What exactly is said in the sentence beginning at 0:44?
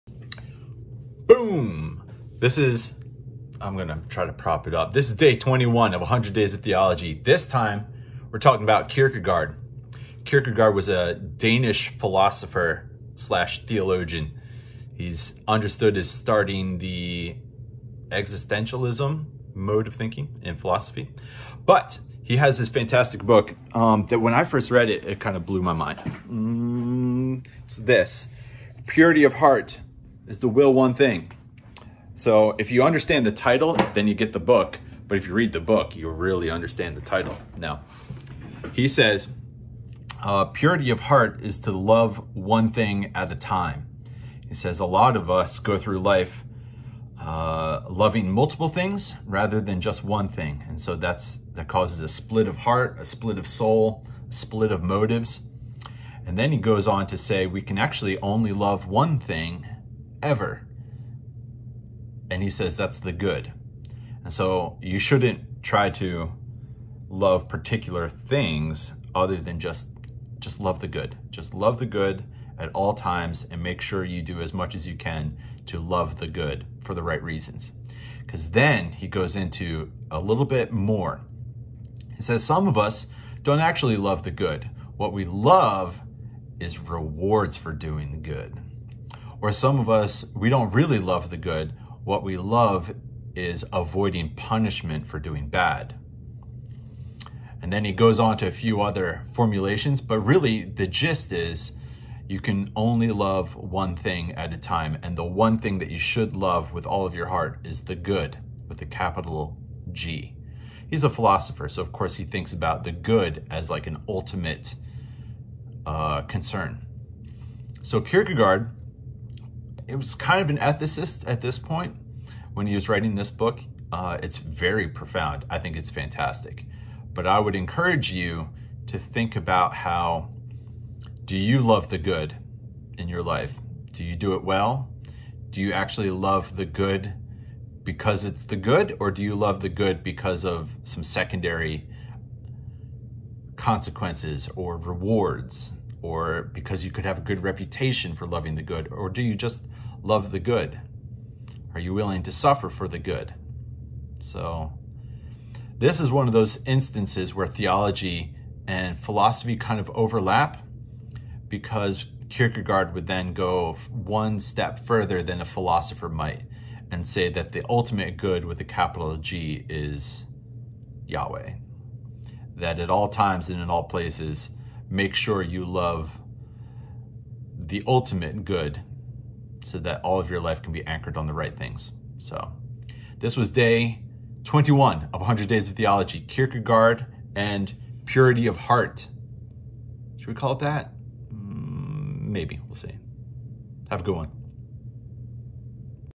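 He says a lot of us go through life uh, loving multiple things rather than just one thing.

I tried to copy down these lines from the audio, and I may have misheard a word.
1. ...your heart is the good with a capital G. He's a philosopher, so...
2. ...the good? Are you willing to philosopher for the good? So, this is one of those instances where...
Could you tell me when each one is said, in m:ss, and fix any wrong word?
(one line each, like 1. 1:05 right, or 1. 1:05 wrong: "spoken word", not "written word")
1. 1:47 right
2. 2:30 wrong: "suffer", not "philosopher".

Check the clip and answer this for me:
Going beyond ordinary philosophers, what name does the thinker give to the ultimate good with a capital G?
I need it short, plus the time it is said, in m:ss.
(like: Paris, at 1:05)
Yahweh, at 2:51.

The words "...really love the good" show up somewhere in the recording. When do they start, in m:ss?
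1:30.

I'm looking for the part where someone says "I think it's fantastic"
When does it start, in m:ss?
2:05.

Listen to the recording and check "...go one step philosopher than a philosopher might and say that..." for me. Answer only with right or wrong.
wrong.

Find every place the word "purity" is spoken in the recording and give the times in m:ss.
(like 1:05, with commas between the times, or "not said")
0:28, 0:40, 3:08.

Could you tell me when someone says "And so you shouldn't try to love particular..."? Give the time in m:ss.
1:04.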